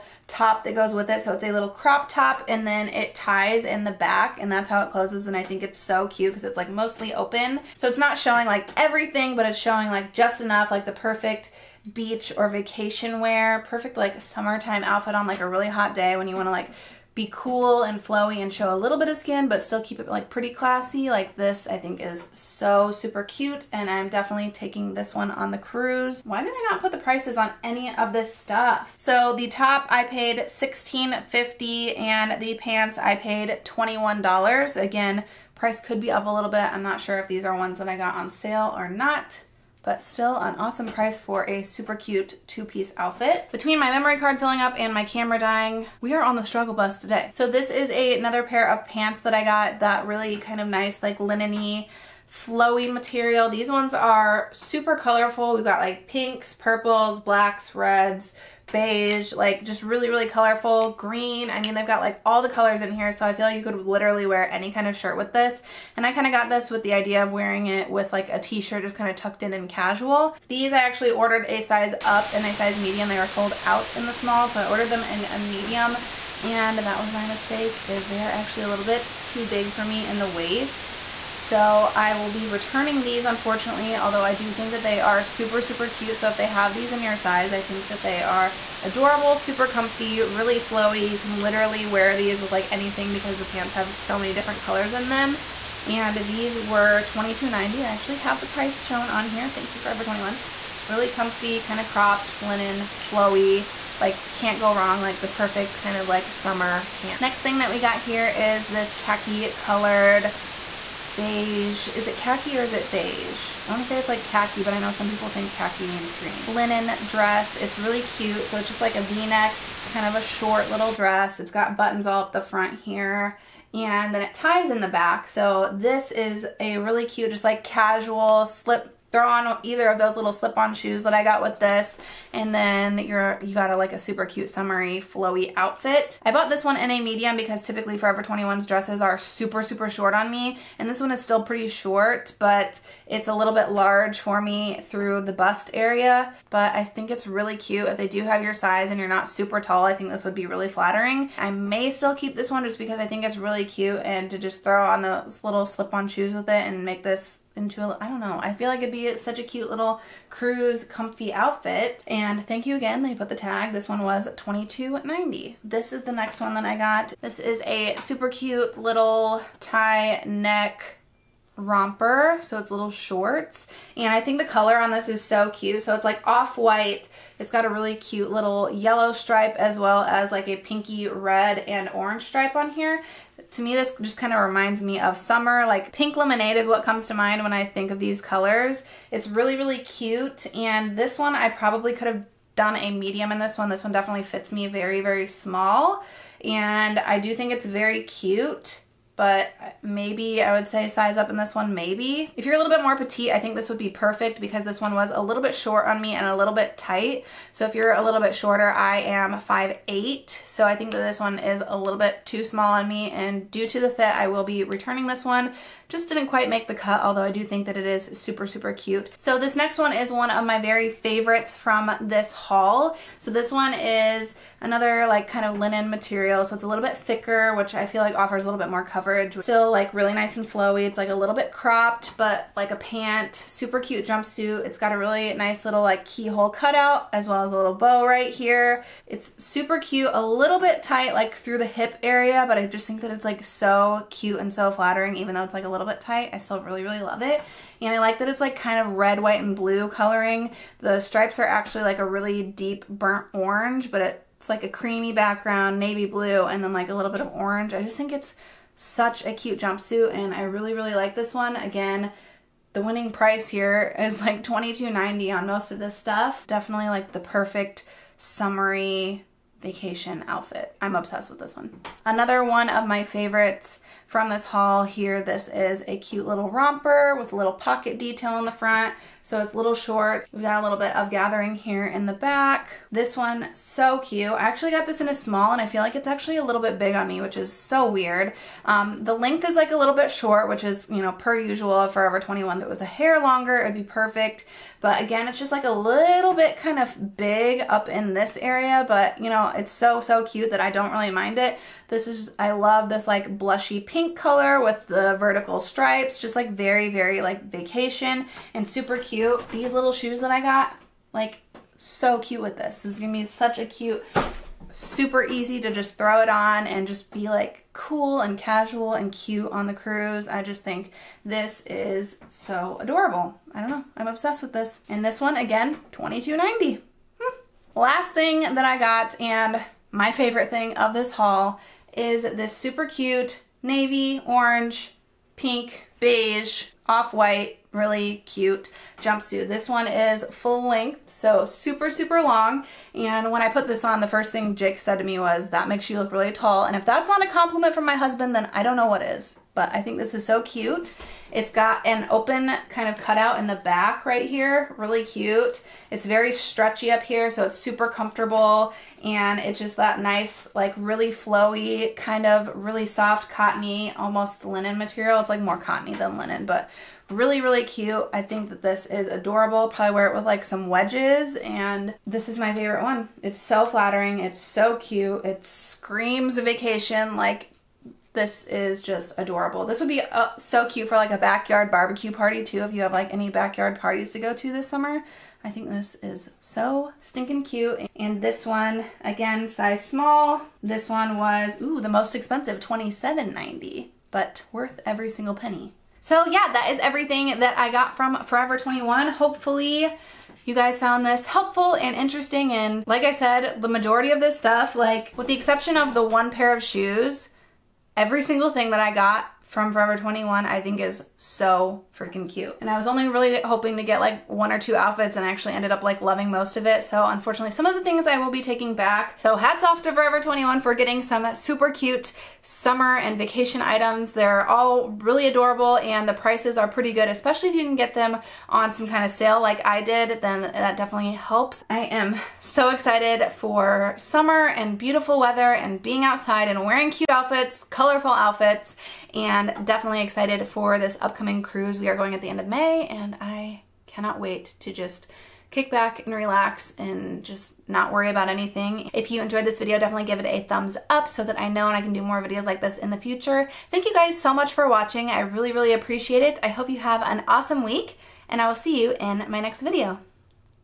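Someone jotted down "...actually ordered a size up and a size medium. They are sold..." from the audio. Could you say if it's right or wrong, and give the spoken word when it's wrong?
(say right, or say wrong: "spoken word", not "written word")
right.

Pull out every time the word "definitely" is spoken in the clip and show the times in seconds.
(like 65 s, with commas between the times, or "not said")
24 s, 193 s, 266 s, 430 s, 439 s, 449 s.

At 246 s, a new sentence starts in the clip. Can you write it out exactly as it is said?
I still really, really love it.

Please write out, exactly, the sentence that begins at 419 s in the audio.
So hats off to Forever 21 for getting some super cute summer and vacation items.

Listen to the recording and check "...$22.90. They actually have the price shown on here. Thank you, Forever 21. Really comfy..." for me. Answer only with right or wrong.
right.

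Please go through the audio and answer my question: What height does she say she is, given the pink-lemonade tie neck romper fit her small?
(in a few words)
5'8".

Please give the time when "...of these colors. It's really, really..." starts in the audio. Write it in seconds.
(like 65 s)
187 s.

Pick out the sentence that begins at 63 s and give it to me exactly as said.
So I feel like you could literally wear any kind of shirt with this.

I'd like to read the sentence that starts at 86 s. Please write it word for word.
So if they have these in your size, I think that they are adorable, super comfy, really flowy.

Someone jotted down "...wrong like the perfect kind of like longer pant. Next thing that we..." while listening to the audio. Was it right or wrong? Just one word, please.
wrong.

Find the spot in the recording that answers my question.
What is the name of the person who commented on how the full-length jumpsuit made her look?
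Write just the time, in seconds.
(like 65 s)
344 s.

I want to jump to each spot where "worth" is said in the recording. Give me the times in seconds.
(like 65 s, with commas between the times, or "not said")
394 s.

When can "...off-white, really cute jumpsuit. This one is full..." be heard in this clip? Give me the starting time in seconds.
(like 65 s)
336 s.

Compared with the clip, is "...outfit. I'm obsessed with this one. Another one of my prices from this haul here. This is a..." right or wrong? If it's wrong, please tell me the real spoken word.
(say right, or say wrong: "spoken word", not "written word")
wrong: "favorites", not "prices".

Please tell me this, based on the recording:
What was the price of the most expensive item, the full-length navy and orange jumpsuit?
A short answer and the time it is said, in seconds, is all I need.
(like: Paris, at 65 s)
$27.90, at 392 s.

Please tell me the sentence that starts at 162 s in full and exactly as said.
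And thank you again, they put the tag.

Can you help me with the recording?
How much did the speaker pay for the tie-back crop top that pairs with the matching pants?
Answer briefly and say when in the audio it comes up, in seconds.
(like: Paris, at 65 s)
$16.50, at 30 s.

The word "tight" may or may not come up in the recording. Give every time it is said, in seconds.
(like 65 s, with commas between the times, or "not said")
206 s, 240 s, 246 s.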